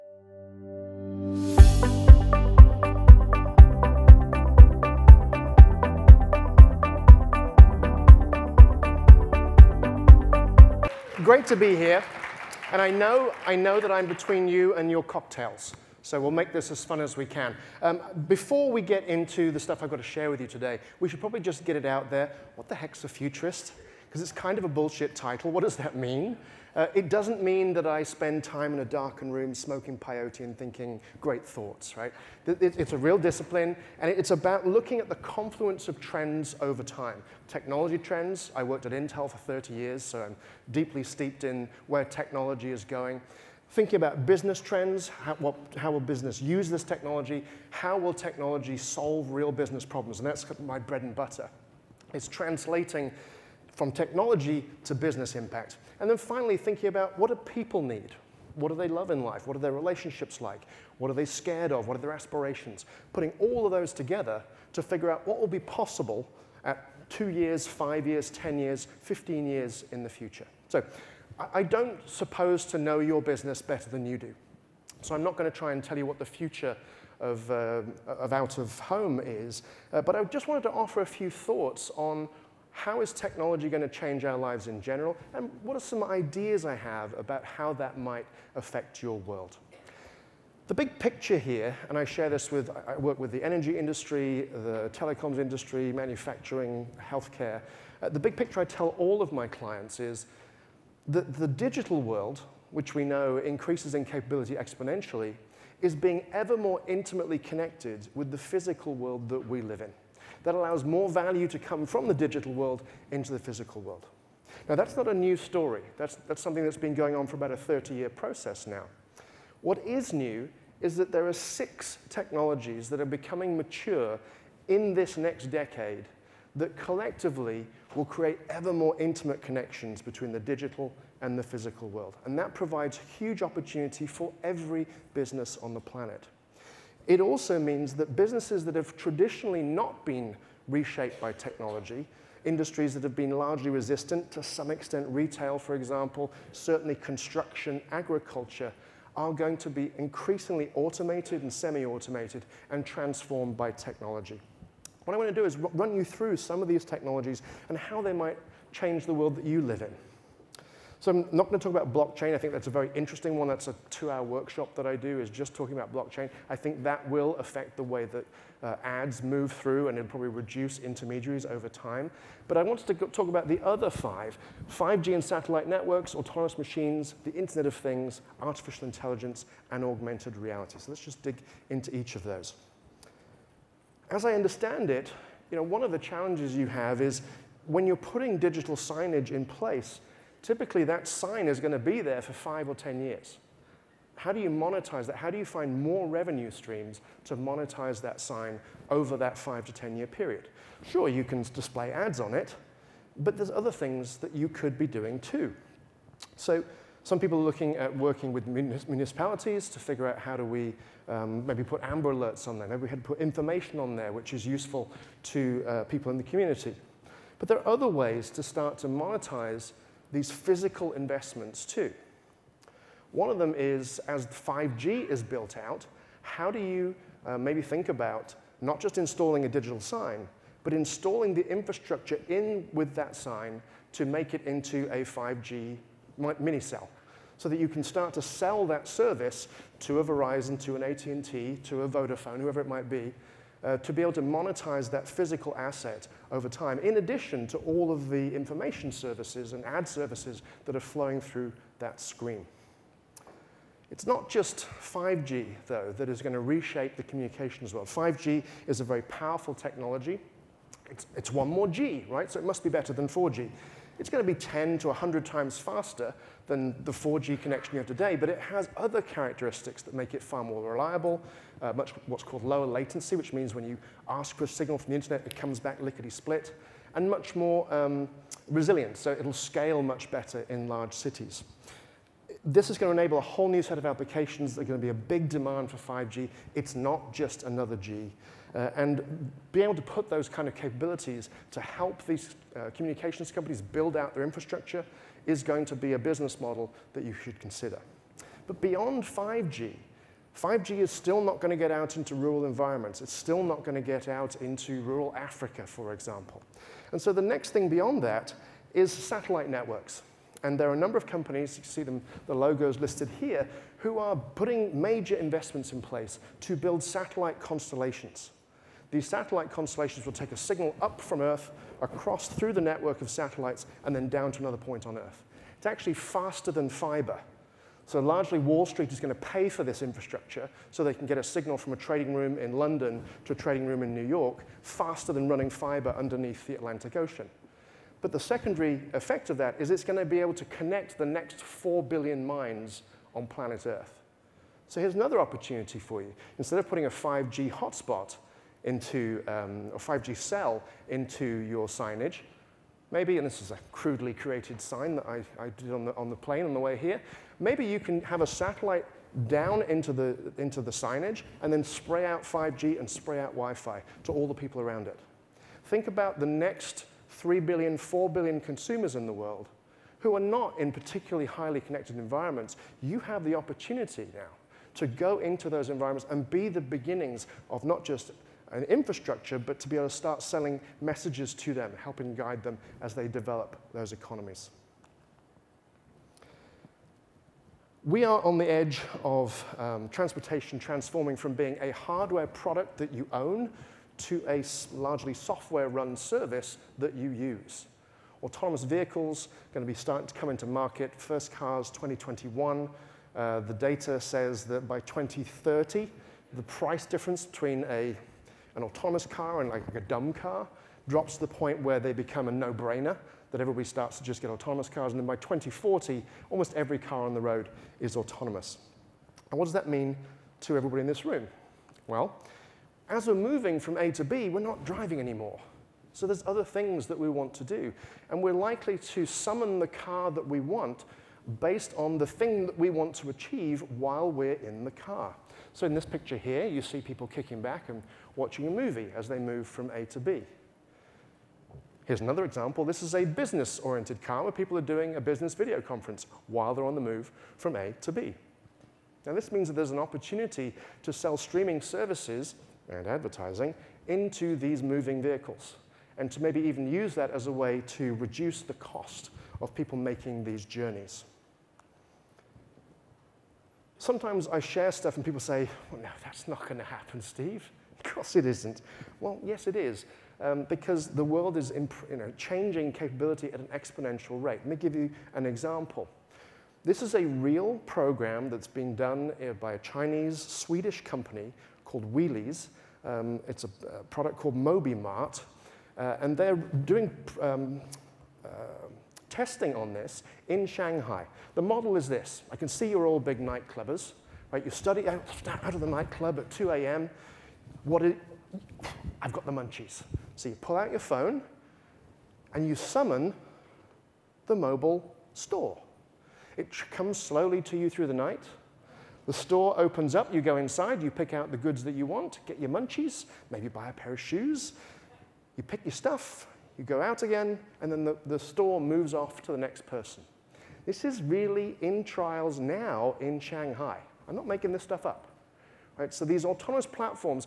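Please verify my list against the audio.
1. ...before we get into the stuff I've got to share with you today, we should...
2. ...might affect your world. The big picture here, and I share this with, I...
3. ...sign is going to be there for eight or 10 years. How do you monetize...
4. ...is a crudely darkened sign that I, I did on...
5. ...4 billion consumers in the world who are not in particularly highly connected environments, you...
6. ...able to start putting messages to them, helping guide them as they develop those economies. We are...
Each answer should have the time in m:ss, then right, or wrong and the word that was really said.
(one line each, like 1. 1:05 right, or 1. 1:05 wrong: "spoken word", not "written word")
1. 0:18 right
2. 1:27 right
3. 3:11 wrong: "five", not "eight"
4. 5:53 wrong: "created", not "darkened"
5. 6:07 right
6. 6:19 wrong: "selling", not "putting".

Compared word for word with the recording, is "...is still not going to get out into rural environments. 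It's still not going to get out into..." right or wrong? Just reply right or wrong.
right.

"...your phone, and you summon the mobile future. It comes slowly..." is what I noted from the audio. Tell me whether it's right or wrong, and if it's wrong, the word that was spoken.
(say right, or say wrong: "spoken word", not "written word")
wrong: "store", not "future".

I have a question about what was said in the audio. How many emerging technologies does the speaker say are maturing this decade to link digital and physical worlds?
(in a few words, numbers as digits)
6.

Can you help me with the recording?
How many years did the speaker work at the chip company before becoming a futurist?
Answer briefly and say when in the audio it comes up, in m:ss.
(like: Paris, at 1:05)
30 years, at 0:39.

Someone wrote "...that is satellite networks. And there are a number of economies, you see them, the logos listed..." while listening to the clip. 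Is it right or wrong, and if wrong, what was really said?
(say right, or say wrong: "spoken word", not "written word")
wrong: "companies", not "economies".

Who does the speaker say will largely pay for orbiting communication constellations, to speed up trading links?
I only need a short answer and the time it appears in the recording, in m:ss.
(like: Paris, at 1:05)
Wall Street, at 5:28.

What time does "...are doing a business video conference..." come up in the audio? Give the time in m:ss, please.
7:24.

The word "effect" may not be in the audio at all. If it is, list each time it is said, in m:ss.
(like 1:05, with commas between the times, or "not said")
5:38.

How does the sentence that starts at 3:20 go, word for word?
Sure, you can display ads on it, but there's other things that you could be doing too.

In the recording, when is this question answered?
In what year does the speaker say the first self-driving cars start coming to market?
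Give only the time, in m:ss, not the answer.
6:41.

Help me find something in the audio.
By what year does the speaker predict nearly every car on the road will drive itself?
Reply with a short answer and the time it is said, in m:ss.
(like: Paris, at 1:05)
2040, at 6:55.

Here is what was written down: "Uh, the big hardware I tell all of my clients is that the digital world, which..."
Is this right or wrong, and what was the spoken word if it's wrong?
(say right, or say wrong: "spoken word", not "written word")
wrong: "picture", not "hardware".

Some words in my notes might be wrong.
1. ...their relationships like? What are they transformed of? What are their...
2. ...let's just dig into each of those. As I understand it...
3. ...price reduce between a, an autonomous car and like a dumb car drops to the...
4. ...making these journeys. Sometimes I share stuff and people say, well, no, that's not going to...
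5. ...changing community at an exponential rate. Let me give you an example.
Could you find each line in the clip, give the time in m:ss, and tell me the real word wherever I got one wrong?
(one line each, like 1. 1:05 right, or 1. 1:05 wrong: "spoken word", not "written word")
1. 0:59 wrong: "scared", not "transformed"
2. 3:00 right
3. 6:46 wrong: "difference", not "reduce"
4. 7:39 right
5. 7:52 wrong: "capability", not "community".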